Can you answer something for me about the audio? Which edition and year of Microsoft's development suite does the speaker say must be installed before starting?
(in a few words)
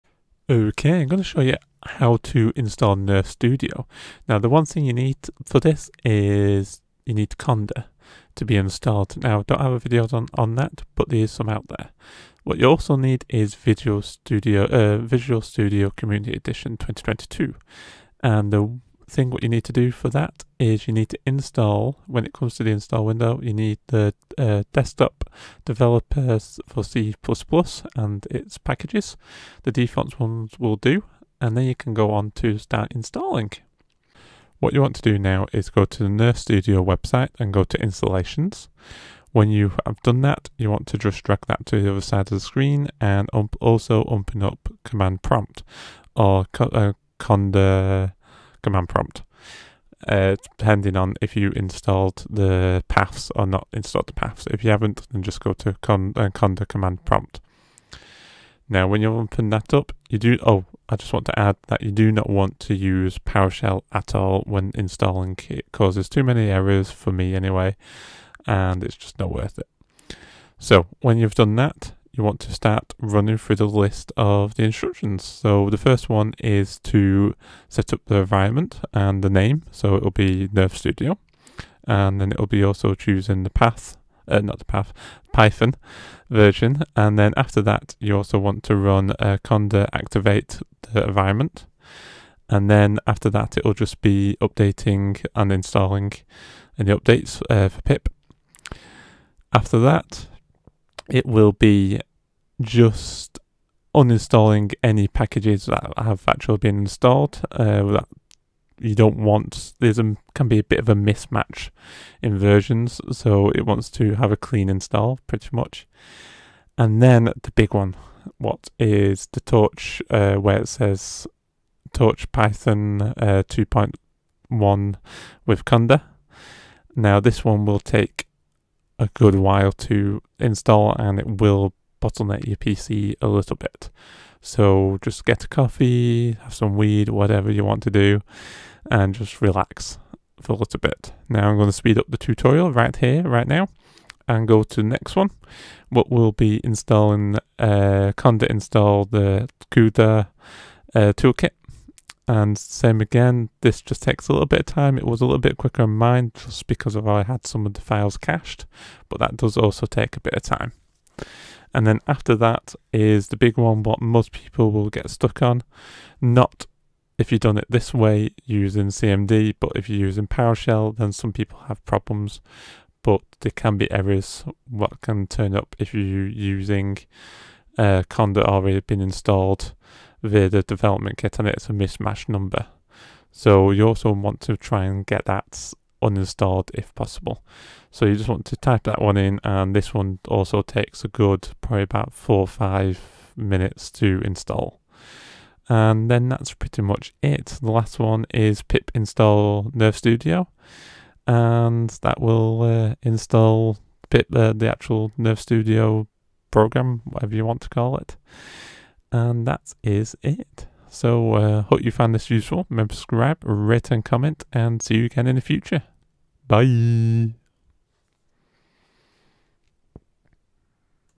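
Community Edition 2022.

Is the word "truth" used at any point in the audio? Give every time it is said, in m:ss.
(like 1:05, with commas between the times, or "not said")
not said.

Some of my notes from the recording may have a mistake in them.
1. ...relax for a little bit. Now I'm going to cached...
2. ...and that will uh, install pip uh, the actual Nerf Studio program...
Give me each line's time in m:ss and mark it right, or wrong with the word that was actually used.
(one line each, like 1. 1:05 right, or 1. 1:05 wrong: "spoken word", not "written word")
1. 2:19 wrong: "speed", not "cached"
2. 3:21 right.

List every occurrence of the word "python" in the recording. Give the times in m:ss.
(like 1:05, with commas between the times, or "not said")
1:25, 2:02.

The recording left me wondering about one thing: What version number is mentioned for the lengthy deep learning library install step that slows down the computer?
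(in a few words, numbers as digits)
2.1.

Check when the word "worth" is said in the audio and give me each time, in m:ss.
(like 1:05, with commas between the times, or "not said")
1:09.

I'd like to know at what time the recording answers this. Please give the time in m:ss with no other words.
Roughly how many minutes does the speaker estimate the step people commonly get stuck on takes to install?
3:12.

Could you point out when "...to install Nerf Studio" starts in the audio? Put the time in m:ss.
0:02.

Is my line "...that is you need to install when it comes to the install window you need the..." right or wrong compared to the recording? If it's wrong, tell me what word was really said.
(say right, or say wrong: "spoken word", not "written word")
right.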